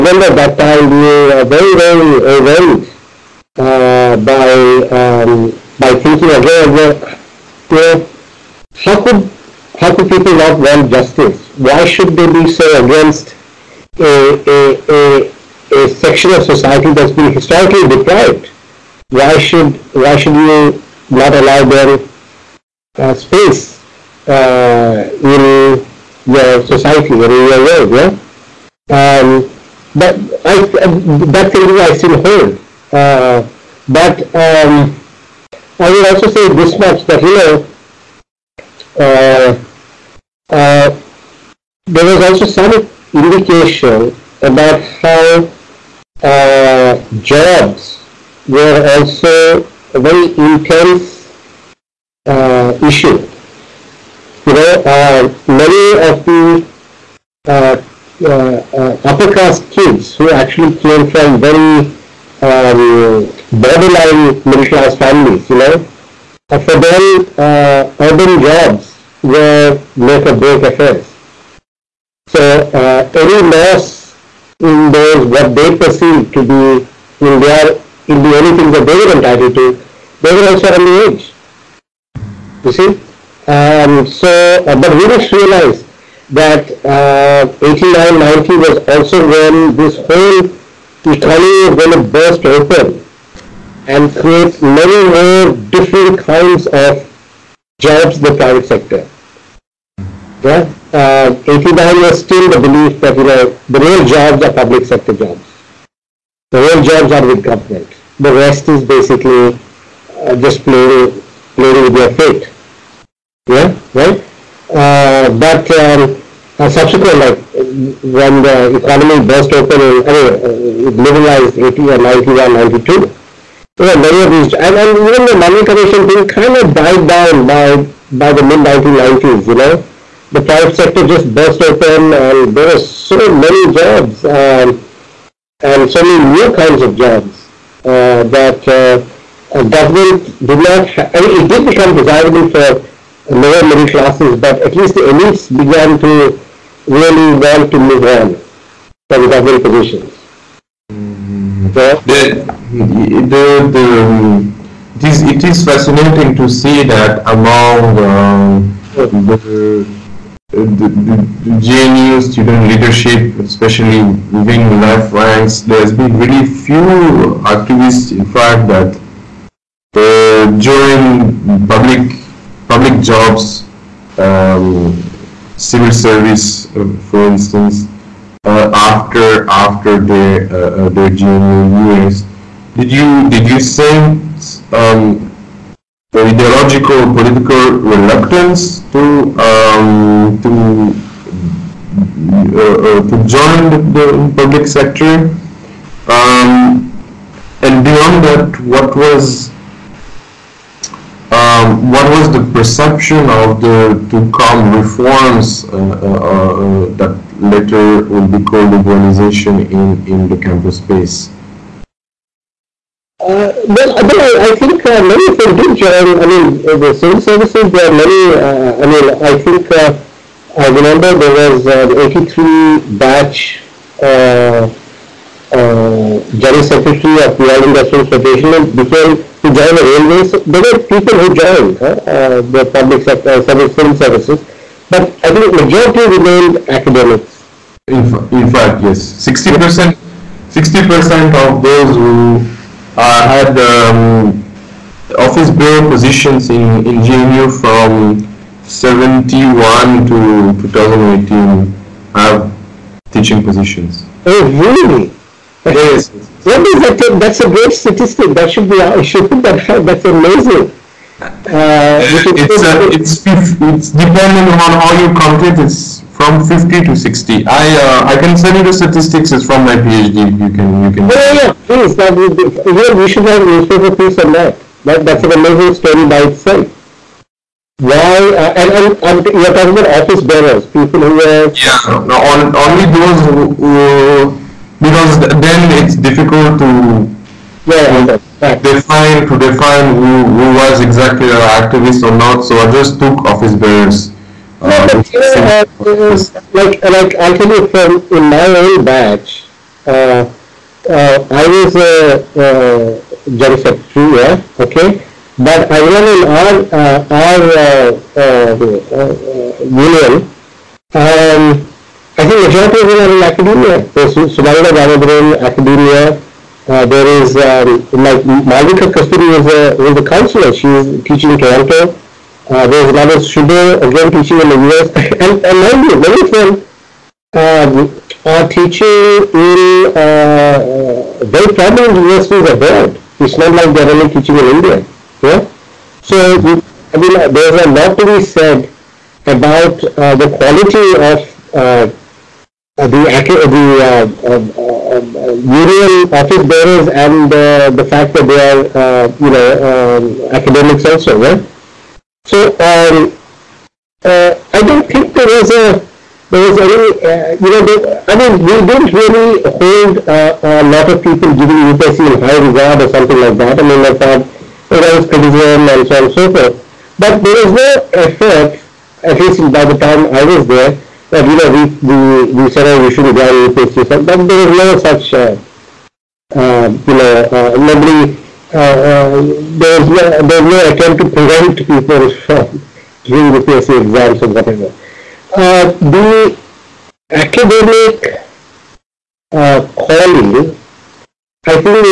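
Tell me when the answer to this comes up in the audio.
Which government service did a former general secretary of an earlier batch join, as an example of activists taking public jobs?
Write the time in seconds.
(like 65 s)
229 s.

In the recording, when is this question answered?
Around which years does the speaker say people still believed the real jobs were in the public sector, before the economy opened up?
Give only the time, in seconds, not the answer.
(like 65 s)
87 s.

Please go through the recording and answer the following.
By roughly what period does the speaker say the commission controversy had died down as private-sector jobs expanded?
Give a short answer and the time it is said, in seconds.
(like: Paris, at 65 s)
mid-1990s, at 128 s.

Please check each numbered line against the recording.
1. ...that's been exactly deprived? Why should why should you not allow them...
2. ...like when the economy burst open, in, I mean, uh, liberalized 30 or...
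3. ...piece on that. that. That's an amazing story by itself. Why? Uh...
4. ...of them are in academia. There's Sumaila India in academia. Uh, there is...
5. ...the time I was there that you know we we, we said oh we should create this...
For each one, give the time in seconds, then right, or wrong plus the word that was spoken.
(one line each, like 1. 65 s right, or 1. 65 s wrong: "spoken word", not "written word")
1. 16 s wrong: "historically", not "exactly"
2. 117 s wrong: "80", not "30"
3. 273 s right
4. 312 s wrong: "Ganadhar", not "India"
5. 369 s wrong: "evaluate", not "create".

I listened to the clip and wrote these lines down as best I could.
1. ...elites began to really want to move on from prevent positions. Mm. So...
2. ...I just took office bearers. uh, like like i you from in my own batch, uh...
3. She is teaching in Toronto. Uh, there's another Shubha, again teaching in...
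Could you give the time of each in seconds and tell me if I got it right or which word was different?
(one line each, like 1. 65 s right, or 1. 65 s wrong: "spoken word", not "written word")
1. 145 s wrong: "government", not "prevent"
2. 292 s right
3. 320 s right.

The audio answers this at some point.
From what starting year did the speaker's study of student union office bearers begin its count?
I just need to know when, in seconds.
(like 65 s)
248 s.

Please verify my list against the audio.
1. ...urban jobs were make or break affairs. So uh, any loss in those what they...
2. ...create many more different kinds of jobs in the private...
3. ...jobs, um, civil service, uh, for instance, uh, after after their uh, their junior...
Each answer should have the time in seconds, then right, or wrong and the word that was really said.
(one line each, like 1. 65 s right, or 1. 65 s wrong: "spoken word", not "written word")
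1. 68 s right
2. 94 s right
3. 173 s right.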